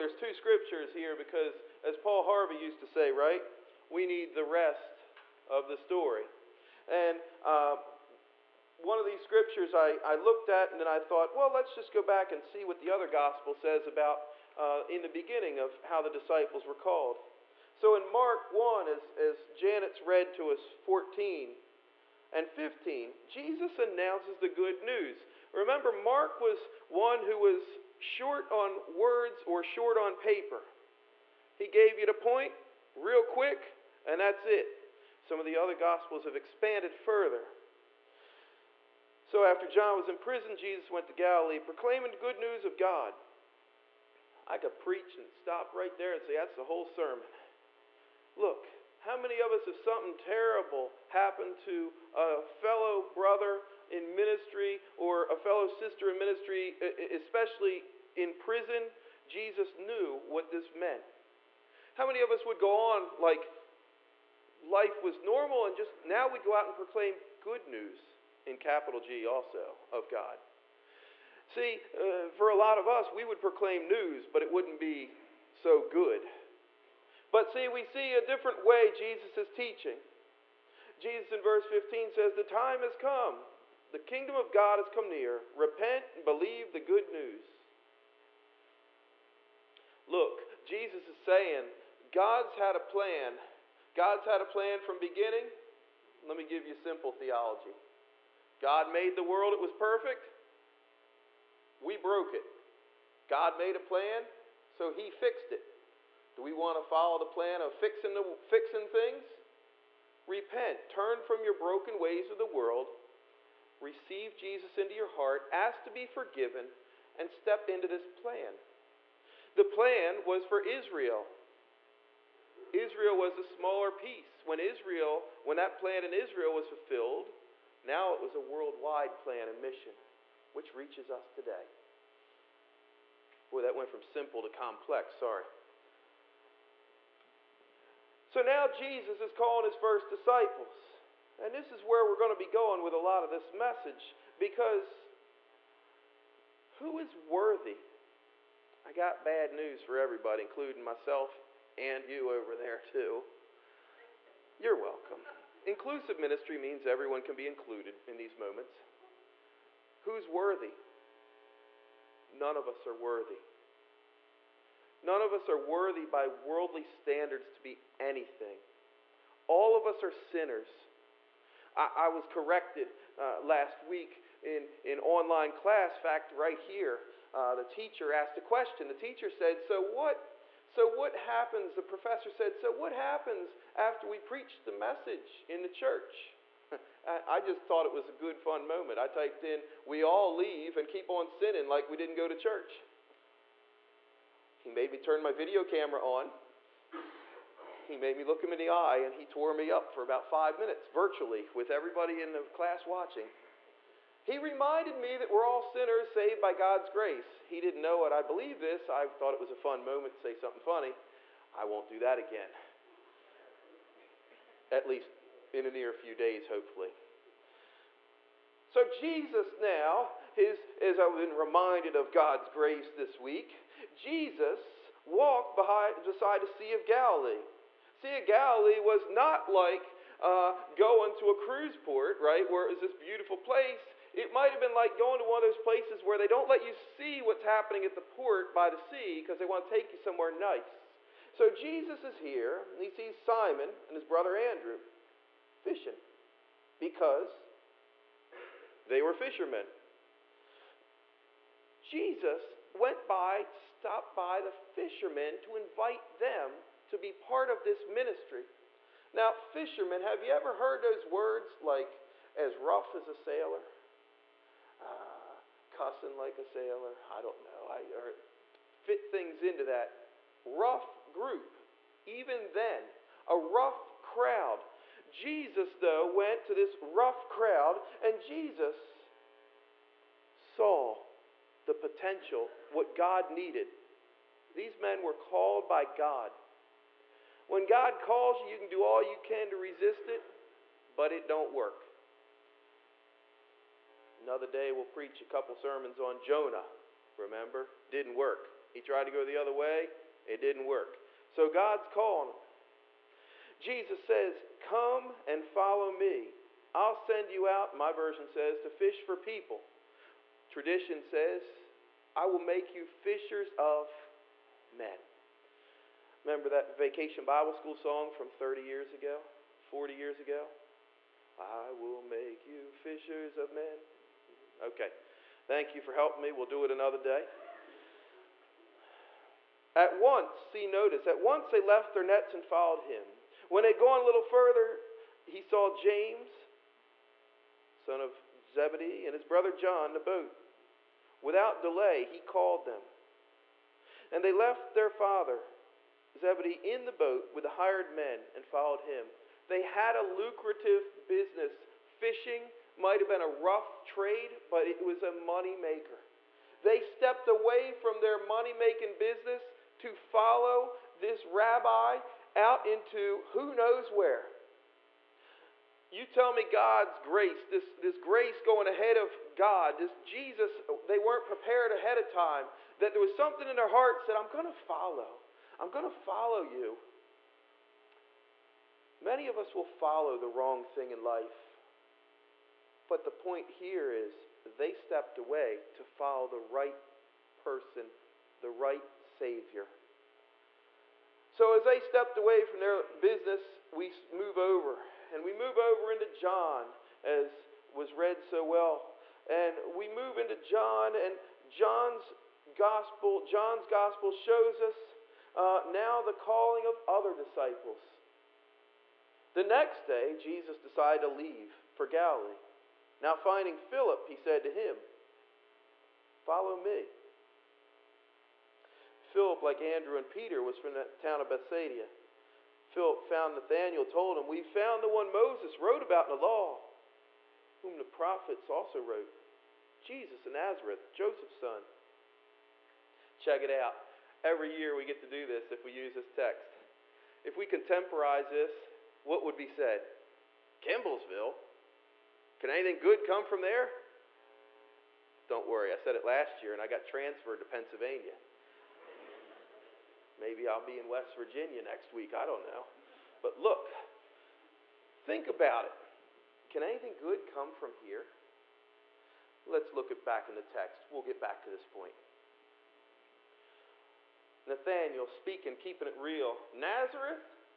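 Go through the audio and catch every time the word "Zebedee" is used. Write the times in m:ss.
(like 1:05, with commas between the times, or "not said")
5:38, 5:46.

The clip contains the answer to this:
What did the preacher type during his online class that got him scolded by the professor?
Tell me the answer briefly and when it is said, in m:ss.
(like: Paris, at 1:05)
We all leave and keep on sinning, at 3:09.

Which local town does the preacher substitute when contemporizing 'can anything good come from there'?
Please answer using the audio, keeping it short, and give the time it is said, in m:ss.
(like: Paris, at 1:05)
Kemblesville, at 7:20.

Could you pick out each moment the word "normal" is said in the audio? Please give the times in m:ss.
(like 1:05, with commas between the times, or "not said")
1:05.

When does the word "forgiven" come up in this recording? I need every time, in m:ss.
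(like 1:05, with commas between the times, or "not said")
1:56.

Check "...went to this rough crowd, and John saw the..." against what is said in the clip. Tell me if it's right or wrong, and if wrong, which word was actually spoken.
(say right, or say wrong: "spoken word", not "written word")
wrong: "Jesus", not "John".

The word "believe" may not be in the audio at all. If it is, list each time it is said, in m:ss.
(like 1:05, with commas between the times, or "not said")
1:26, 3:28.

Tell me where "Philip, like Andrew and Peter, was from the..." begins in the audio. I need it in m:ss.
6:59.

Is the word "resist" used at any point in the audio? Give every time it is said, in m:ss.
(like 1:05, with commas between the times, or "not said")
4:49.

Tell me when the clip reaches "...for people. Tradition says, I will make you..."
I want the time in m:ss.
5:09.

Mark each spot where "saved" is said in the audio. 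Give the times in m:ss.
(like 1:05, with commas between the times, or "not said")
3:26.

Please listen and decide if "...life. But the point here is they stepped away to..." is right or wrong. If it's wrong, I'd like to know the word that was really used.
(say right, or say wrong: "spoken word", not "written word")
right.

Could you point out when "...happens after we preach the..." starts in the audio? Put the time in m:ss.
3:02.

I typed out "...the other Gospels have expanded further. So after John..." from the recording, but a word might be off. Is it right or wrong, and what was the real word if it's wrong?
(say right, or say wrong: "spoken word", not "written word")
right.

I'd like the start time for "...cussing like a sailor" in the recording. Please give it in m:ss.
4:25.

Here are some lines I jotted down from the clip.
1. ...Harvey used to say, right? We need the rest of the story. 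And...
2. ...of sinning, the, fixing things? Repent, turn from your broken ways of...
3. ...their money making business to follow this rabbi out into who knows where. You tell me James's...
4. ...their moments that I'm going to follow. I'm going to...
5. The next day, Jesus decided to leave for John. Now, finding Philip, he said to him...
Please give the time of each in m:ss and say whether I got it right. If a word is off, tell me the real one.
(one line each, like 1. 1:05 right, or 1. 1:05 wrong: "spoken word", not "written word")
1. 0:02 right
2. 1:47 wrong: "fixing", not "sinning"
3. 5:57 wrong: "God", not "James"
4. 6:13 wrong: "hearts", not "moments"
5. 6:49 wrong: "Galilee", not "John".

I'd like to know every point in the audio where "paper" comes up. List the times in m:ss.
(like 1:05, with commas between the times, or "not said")
0:30.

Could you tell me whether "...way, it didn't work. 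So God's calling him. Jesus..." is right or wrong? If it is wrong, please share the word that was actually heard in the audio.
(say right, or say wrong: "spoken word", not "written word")
right.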